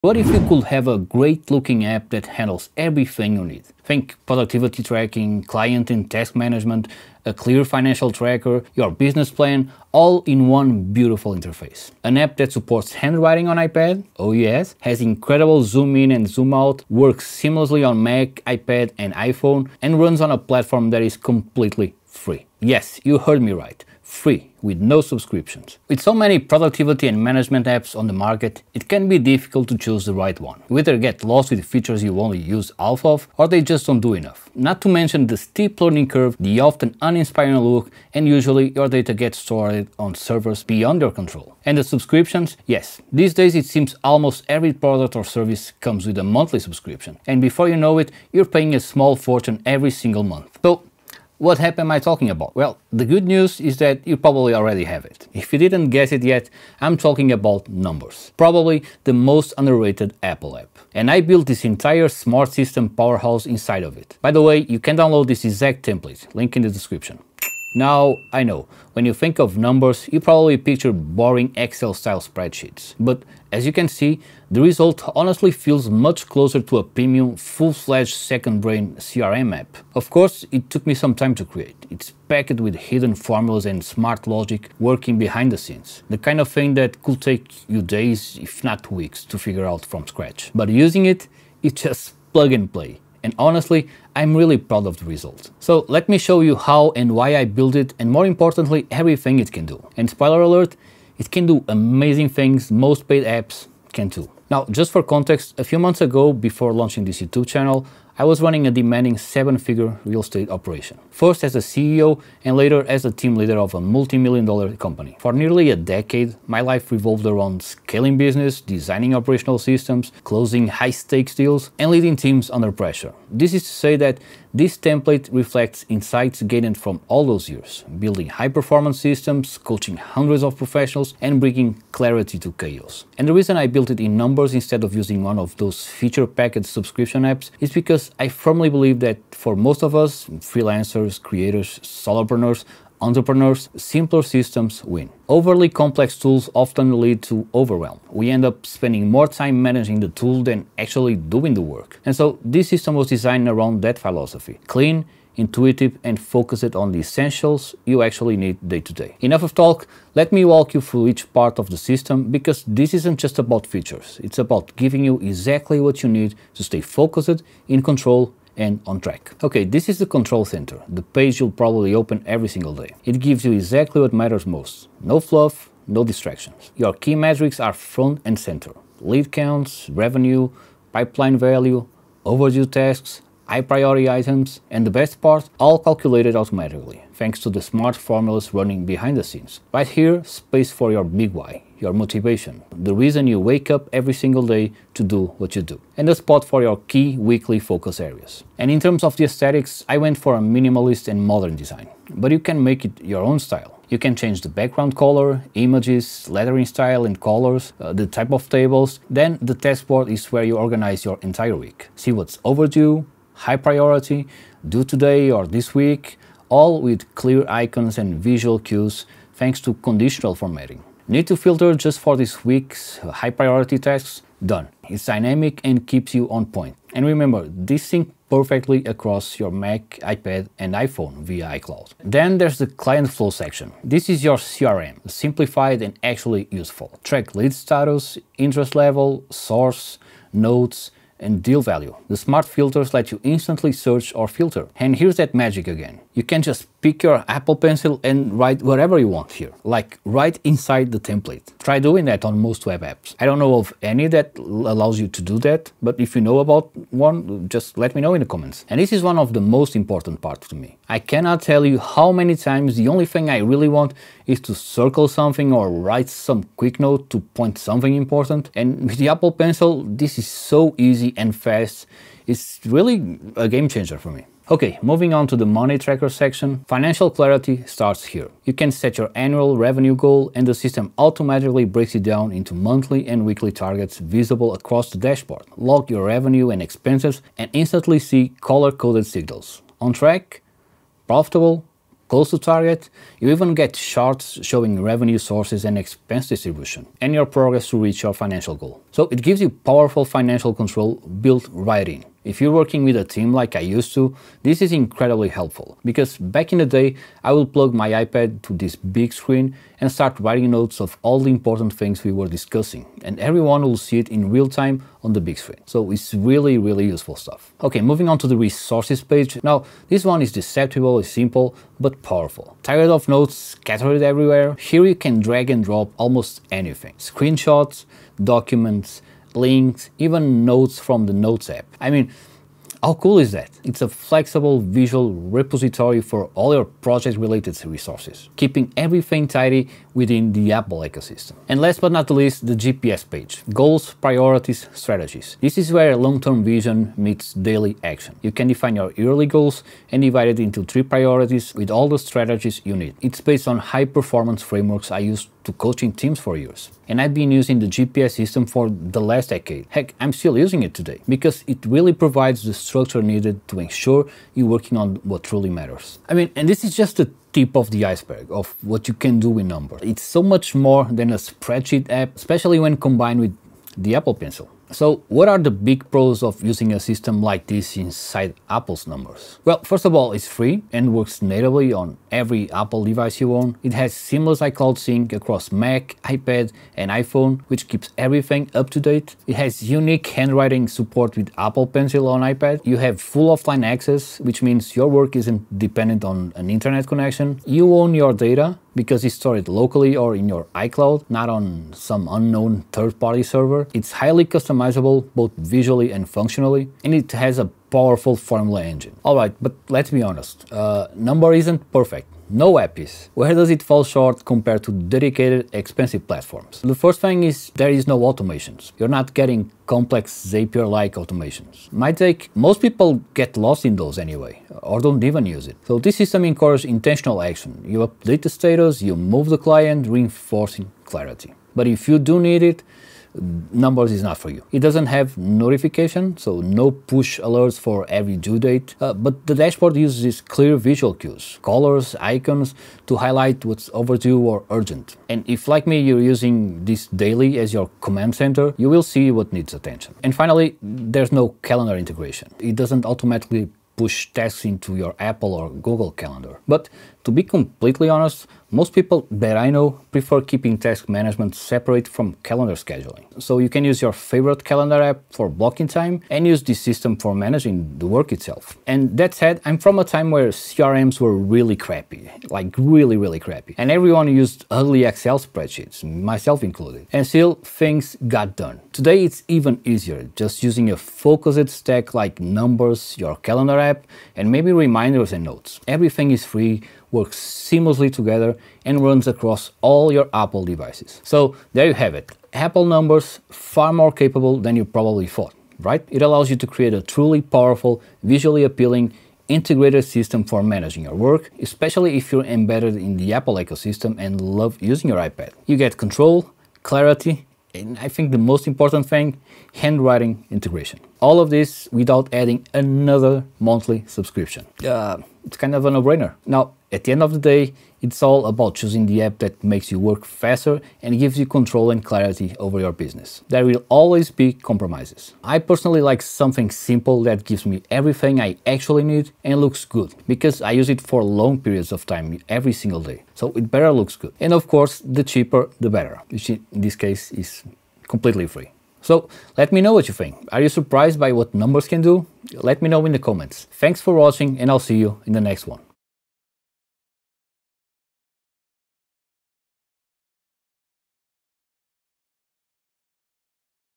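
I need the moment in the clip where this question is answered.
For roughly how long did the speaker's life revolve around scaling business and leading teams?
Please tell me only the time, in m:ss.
1:55.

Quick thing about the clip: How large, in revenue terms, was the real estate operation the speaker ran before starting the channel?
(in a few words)
seven-figure.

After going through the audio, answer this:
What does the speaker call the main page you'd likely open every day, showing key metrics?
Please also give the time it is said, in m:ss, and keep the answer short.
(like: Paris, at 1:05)
control center, at 2:50.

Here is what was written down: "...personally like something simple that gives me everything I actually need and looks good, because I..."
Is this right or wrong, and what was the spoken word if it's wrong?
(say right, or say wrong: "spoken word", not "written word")
right.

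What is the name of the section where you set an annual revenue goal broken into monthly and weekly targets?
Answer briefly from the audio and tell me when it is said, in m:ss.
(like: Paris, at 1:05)
money tracker, at 4:35.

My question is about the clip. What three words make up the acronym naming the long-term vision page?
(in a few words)
goals, priorities, strategies.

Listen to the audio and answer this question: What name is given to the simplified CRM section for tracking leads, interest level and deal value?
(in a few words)
client flow.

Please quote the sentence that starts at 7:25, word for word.
And if like me you're using this daily as your command center, you will see what needs attention.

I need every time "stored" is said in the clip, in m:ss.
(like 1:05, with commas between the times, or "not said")
0:39, 6:39.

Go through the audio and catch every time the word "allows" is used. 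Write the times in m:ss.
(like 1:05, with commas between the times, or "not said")
4:14, 8:16.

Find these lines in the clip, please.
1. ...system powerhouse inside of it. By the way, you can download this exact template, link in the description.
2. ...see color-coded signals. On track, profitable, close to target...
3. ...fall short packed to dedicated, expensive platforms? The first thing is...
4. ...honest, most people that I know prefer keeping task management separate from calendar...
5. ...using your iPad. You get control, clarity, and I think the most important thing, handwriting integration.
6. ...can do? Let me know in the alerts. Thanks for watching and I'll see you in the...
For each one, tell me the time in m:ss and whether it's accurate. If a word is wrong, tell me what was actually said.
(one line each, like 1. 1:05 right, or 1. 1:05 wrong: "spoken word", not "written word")
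1. 1:02 right
2. 4:47 right
3. 6:53 wrong: "compared", not "packed"
4. 7:37 right
5. 8:24 right
6. 9:01 wrong: "comments", not "alerts".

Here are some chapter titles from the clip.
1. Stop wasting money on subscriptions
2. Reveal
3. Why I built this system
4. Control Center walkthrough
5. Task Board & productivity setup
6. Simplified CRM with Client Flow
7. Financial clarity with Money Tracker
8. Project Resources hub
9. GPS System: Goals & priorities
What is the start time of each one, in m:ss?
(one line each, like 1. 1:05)
1. 0:26
2. 0:52
3. 1:42
4. 2:50
5. 3:30
6. 3:52
7. 4:35
8. 5:17
9. 5:42.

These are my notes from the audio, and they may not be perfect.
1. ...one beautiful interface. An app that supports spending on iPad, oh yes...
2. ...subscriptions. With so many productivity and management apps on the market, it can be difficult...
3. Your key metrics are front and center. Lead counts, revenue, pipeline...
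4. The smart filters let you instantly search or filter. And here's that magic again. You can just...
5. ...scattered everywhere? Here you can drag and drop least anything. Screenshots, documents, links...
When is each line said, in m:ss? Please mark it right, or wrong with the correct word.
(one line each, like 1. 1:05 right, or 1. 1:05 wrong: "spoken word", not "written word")
1. 0:10 wrong: "handwriting", not "spending"
2. 0:25 right
3. 2:56 right
4. 4:02 right
5. 5:23 wrong: "almost", not "least".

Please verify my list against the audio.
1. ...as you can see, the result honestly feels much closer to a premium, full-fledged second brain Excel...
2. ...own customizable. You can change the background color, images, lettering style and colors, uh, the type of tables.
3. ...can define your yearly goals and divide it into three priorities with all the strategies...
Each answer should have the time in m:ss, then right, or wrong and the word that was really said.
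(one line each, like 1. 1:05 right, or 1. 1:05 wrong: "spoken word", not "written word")
1. 1:13 wrong: "CRM", not "Excel"
2. 3:23 wrong: "style", not "customizable"
3. 5:48 right.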